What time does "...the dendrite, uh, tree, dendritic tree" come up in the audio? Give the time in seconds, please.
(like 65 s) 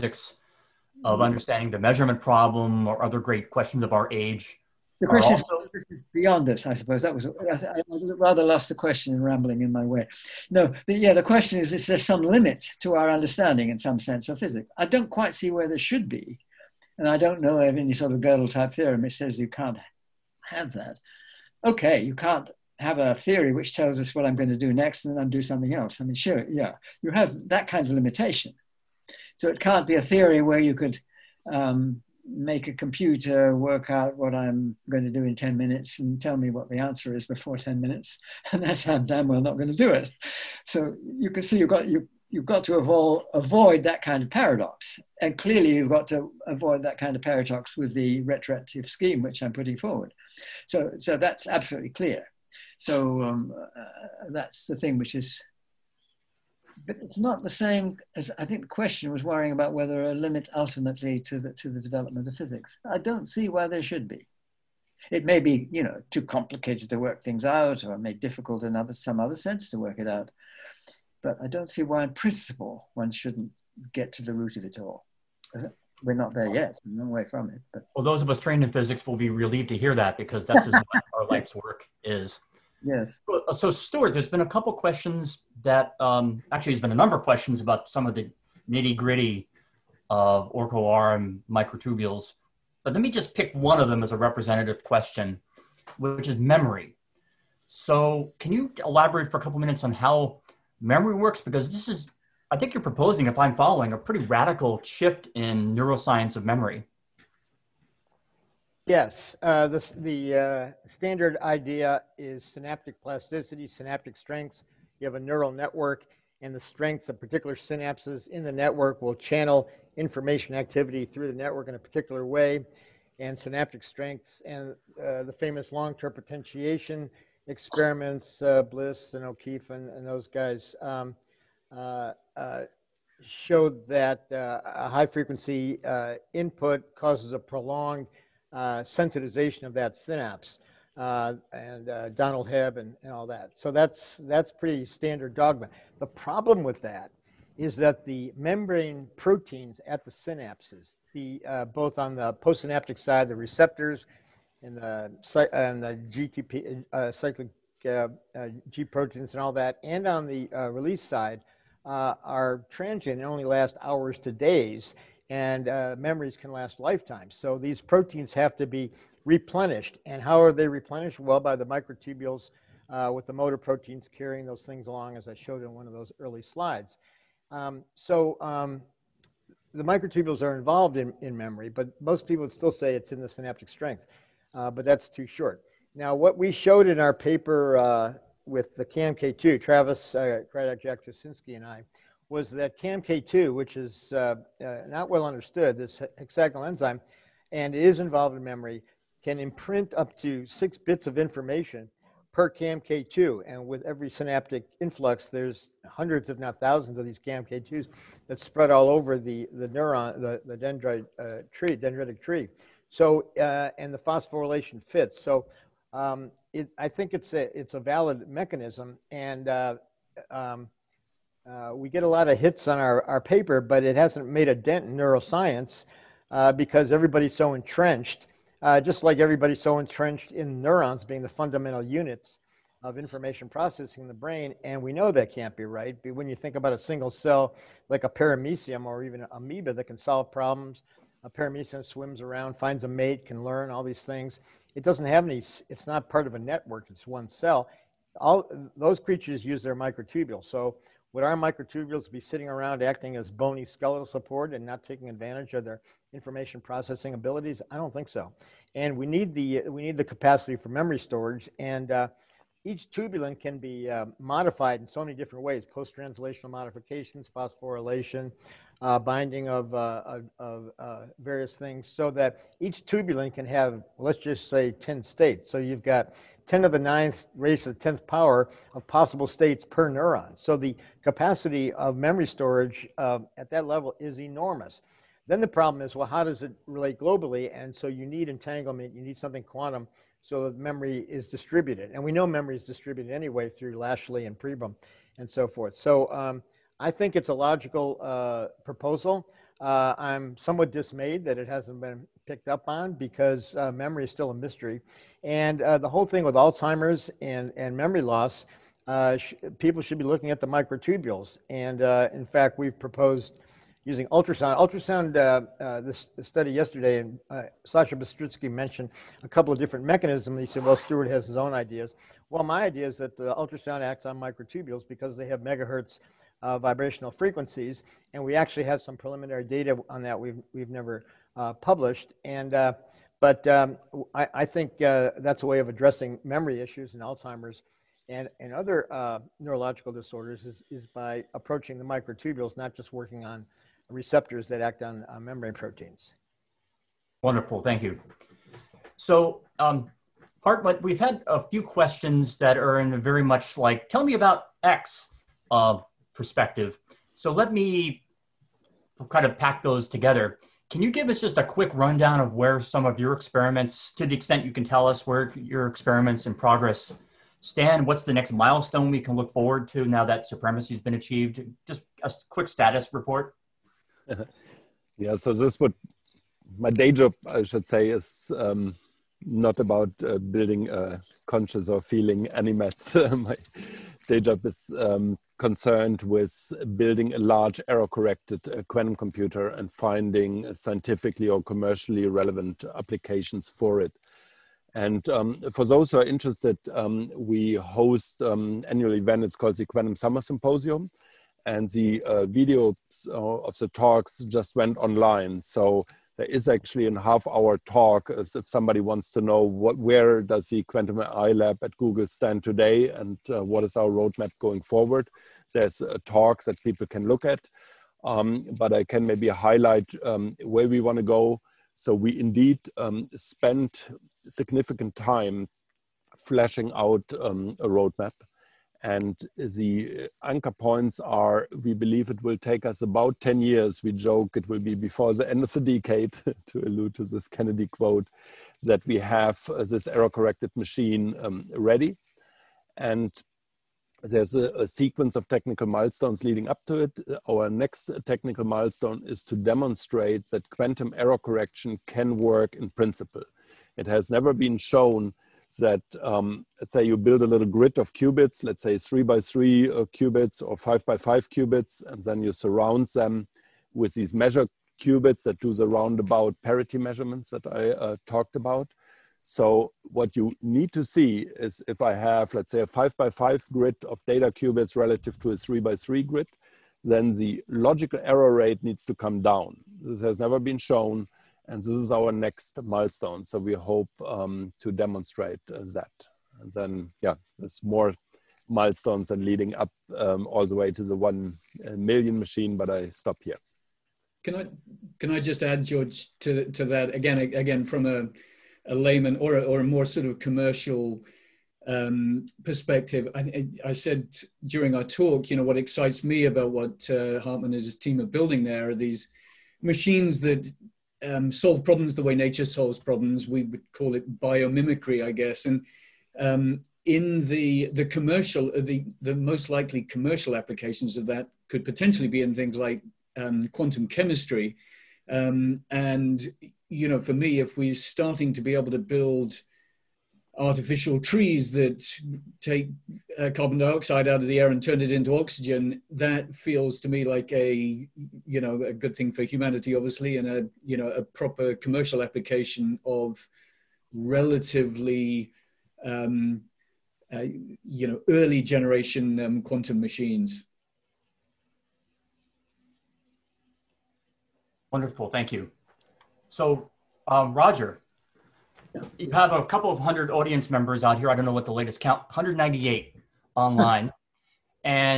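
210 s.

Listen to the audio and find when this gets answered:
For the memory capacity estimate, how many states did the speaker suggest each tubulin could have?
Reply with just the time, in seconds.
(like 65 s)
274 s.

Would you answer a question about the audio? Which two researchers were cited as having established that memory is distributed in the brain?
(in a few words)
Lashley and Pribram.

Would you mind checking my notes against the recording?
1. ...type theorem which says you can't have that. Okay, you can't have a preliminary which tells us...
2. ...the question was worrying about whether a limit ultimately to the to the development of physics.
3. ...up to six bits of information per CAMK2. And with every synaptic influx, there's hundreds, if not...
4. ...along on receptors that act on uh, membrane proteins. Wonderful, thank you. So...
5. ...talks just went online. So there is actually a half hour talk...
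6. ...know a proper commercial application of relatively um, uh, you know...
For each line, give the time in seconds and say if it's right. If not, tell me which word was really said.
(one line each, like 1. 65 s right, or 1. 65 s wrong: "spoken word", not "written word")
1. 18 s wrong: "theory", not "preliminary"
2. 58 s right
3. 199 s right
4. 342 s wrong: "working", not "along"
5. 403 s right
6. 540 s right.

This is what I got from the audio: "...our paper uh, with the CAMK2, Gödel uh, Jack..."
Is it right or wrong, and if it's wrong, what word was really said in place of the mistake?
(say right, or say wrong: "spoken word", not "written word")
wrong: "Travis", not "Gödel".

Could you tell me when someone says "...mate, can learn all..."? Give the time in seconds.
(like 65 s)
242 s.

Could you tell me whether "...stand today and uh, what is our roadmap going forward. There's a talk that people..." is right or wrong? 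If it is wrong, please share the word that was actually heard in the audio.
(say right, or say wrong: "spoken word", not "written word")
right.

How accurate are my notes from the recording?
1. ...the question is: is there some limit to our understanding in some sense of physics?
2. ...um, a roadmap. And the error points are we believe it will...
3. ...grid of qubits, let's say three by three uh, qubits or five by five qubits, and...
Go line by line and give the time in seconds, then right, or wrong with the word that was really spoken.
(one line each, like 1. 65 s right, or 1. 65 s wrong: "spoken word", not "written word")
1. 11 s right
2. 427 s wrong: "anchor", not "error"
3. 457 s right.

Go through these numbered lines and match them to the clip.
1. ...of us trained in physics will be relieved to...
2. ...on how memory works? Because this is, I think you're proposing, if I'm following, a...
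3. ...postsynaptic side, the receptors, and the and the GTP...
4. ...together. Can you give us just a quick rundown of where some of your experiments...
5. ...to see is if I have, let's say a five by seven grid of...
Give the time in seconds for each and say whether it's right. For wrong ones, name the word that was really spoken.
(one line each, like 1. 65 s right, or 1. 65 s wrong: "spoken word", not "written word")
1. 78 s right
2. 99 s right
3. 152 s right
4. 359 s right
5. 470 s wrong: "five", not "seven".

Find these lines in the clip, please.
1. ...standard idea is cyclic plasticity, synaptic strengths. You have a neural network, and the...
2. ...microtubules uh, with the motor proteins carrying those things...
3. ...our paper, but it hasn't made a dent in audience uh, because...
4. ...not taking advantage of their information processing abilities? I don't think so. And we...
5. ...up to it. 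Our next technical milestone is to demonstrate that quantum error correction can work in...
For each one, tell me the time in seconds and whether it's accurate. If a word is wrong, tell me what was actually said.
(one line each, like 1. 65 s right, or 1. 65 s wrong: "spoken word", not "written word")
1. 110 s wrong: "synaptic", not "cyclic"
2. 171 s right
3. 223 s wrong: "neuroscience", not "audience"
4. 254 s right
5. 446 s right.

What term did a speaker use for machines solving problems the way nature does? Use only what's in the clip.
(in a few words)
biomimicry.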